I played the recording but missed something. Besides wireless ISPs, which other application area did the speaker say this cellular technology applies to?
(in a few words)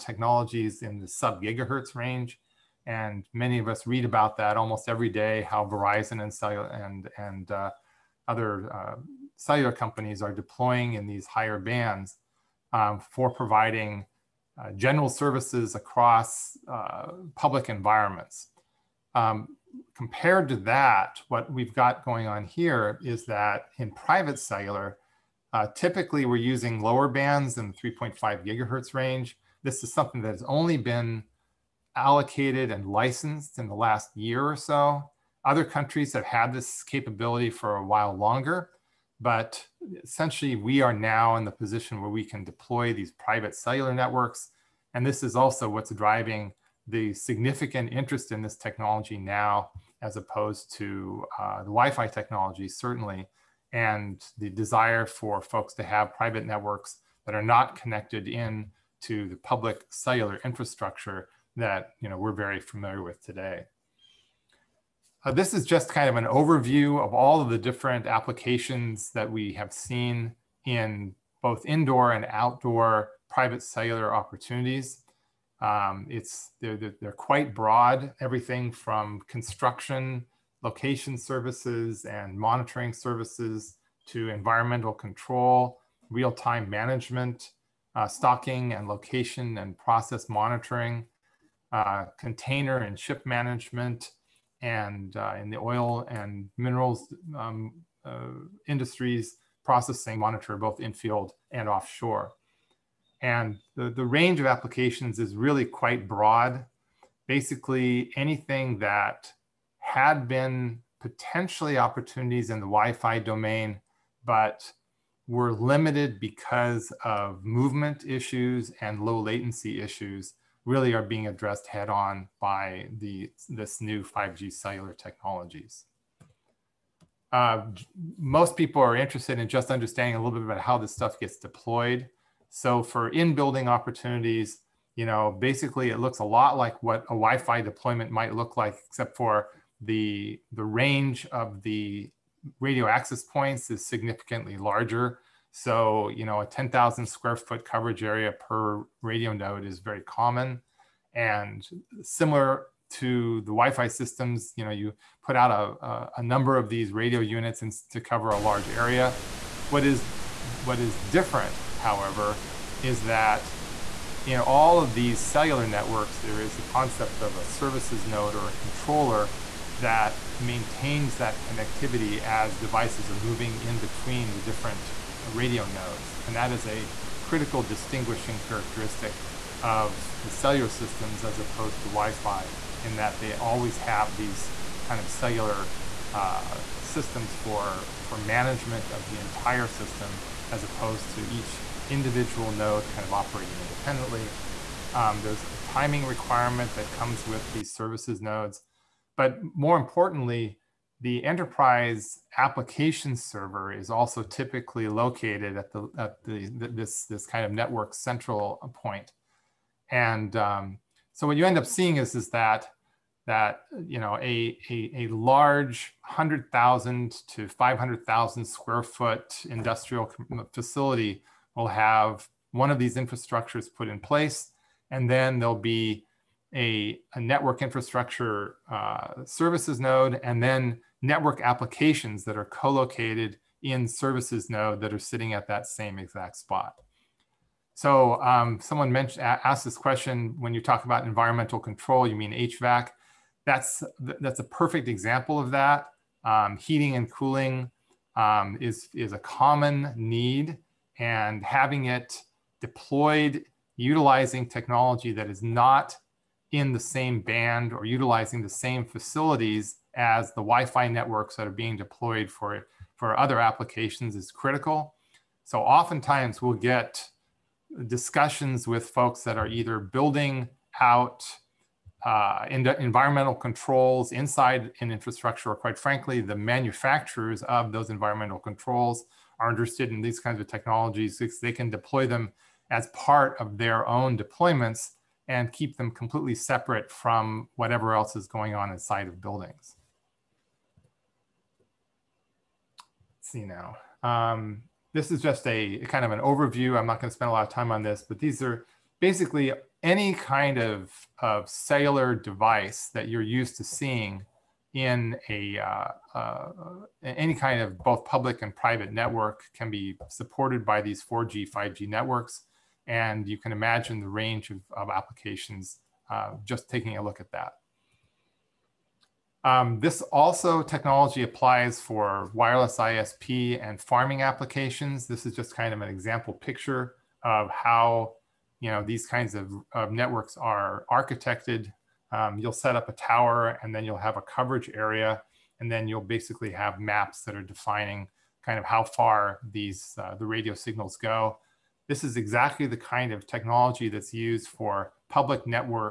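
farming.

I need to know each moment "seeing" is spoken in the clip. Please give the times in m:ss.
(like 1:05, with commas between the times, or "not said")
3:31, 5:03.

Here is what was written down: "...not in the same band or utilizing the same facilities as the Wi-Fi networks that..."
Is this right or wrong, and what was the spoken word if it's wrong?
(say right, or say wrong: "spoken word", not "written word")
right.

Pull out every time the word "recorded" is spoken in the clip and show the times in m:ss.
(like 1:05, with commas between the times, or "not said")
not said.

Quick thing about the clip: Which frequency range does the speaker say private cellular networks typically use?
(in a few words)
3.5 gigahertz.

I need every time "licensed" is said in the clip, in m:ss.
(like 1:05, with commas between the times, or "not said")
0:32.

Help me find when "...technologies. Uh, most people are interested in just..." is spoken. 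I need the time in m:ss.
2:04.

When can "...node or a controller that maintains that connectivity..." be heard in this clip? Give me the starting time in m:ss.
2:48.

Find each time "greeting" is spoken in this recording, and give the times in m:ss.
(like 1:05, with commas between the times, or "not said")
not said.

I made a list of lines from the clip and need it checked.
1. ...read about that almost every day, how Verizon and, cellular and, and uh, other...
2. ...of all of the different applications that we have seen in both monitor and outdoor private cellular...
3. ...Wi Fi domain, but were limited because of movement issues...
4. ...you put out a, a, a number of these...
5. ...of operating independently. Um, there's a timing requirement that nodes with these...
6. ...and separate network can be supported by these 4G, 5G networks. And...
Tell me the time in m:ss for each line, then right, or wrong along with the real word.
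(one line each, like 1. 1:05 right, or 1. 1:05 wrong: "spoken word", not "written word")
1. 0:03 right
2. 1:07 wrong: "indoor", not "monitor"
3. 1:52 right
4. 2:34 right
5. 3:13 wrong: "comes", not "nodes"
6. 5:08 wrong: "private", not "separate".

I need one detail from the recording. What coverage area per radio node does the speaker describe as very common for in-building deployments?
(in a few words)
10,000 square feet.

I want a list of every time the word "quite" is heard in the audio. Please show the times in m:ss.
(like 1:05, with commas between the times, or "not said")
1:17, 1:45, 4:35.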